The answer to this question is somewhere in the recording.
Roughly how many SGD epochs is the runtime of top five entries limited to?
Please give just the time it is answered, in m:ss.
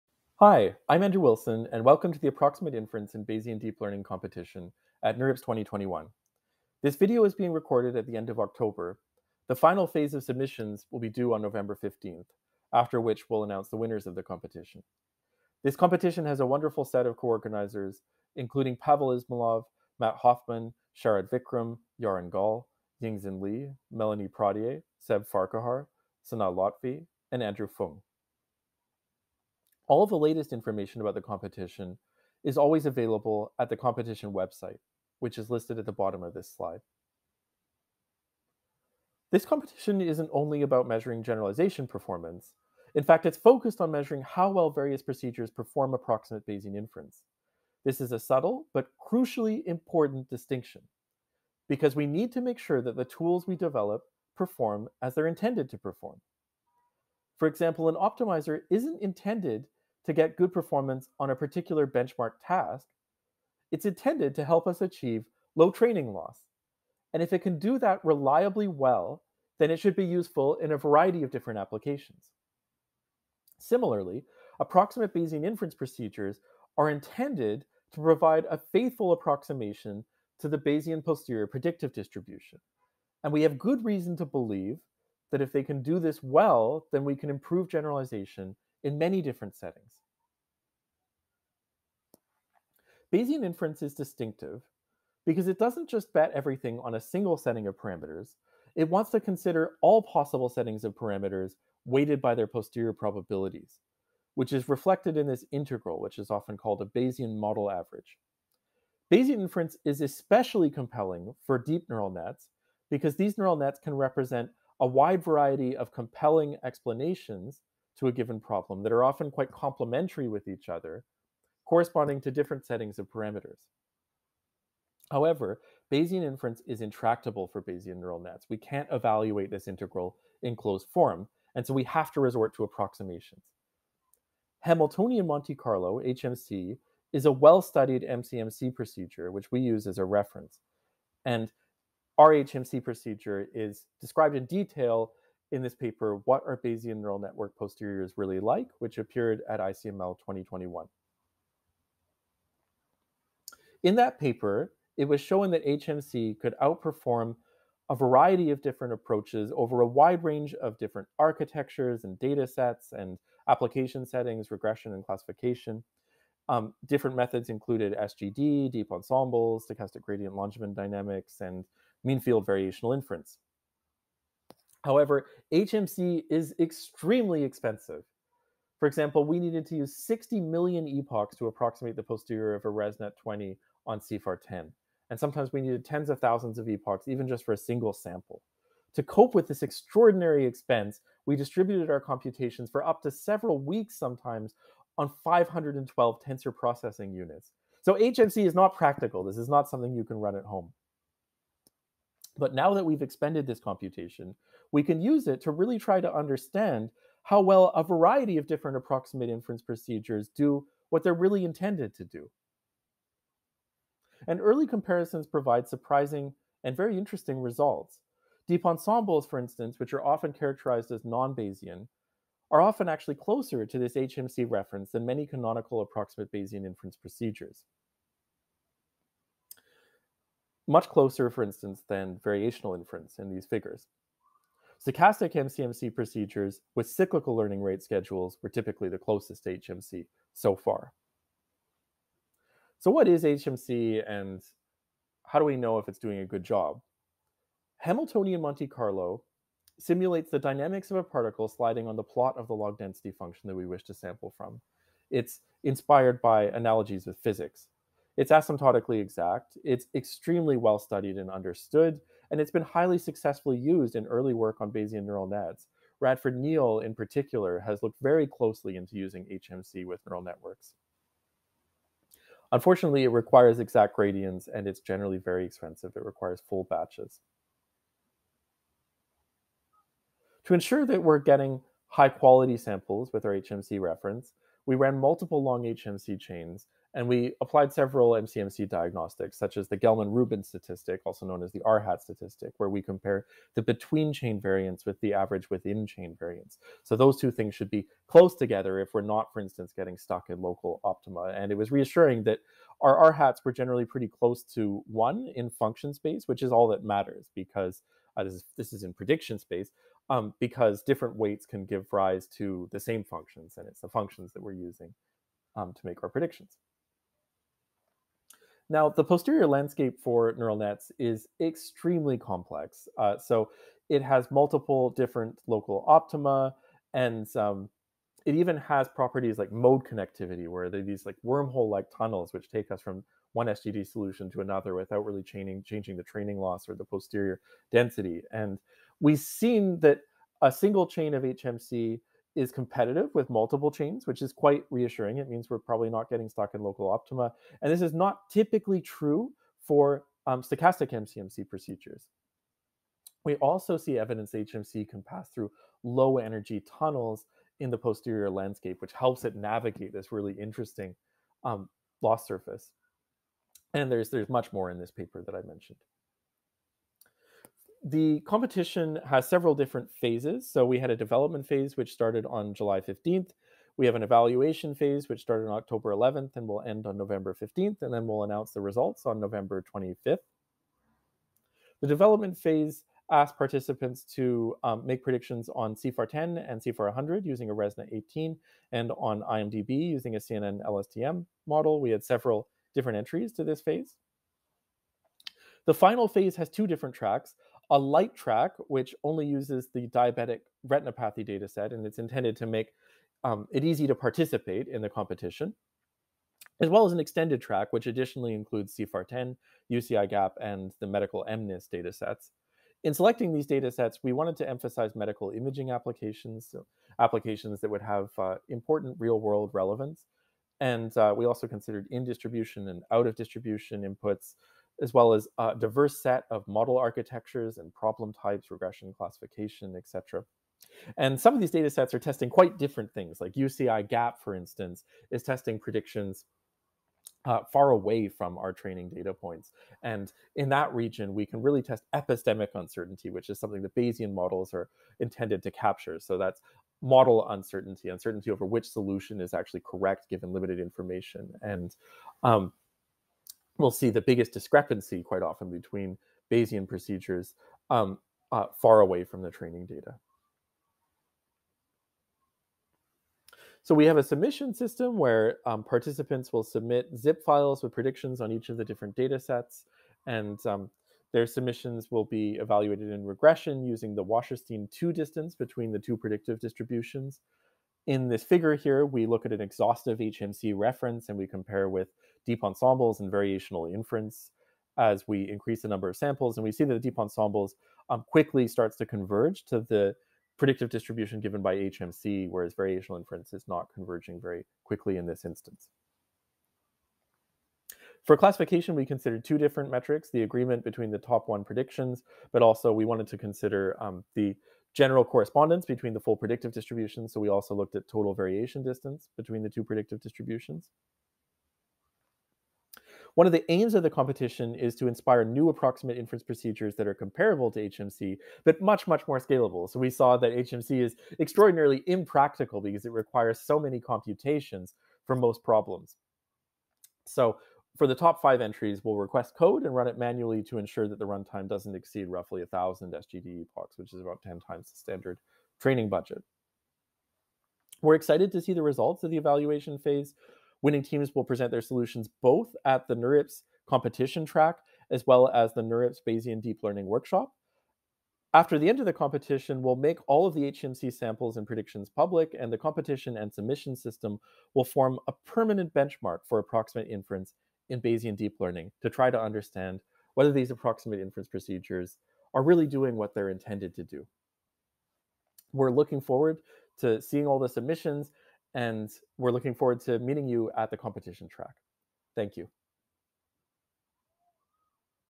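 8:52.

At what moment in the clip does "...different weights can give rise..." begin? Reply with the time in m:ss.
5:10.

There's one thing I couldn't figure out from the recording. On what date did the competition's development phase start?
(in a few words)
July 15th.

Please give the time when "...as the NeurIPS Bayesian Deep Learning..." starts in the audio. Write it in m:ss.
9:05.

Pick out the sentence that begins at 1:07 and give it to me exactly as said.
And if it can do that reliably well, then it should be useful in a variety of different applications.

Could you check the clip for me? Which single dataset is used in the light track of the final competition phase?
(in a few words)
diabetic retinopathy.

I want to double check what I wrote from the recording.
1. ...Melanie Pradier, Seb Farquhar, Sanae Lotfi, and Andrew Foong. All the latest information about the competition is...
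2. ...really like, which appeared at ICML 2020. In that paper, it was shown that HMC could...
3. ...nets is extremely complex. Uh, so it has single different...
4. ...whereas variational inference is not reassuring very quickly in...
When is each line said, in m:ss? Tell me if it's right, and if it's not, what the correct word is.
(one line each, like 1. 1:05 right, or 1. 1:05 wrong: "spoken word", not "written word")
1. 0:23 right
2. 2:28 wrong: "2021", not "2020"
3. 5:20 wrong: "multiple", not "single"
4. 8:12 wrong: "converging", not "reassuring".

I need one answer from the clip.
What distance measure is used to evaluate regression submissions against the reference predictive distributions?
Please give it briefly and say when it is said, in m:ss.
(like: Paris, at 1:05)
Wasserstein 2 distance, at 7:54.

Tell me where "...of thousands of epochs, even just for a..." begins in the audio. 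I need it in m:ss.
3:06.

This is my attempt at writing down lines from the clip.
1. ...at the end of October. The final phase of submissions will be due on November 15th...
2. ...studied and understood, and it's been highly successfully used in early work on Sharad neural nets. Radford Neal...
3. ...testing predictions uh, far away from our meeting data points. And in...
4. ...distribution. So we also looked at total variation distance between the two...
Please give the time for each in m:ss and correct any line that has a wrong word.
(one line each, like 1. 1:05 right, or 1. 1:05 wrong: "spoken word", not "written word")
1. 0:07 right
2. 4:20 wrong: "Bayesian", not "Sharad"
3. 7:15 wrong: "training", not "meeting"
4. 8:26 right.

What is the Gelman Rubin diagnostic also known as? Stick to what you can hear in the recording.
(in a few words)
RHAT statistic.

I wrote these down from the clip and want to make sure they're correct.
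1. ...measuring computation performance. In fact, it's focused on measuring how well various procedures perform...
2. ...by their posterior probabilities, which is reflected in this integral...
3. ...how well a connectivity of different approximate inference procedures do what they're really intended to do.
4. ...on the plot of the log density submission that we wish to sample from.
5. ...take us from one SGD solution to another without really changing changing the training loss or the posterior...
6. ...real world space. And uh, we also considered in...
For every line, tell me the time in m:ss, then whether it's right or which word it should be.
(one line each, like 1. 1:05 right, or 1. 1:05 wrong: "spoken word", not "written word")
1. 0:40 wrong: "generalization", not "computation"
2. 1:42 right
3. 3:27 wrong: "variety", not "connectivity"
4. 4:11 wrong: "function", not "submission"
5. 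5:32 right
6. 6:58 wrong: "relevance", not "space".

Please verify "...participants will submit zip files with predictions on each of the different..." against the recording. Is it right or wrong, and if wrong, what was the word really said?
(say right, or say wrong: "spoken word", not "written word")
right.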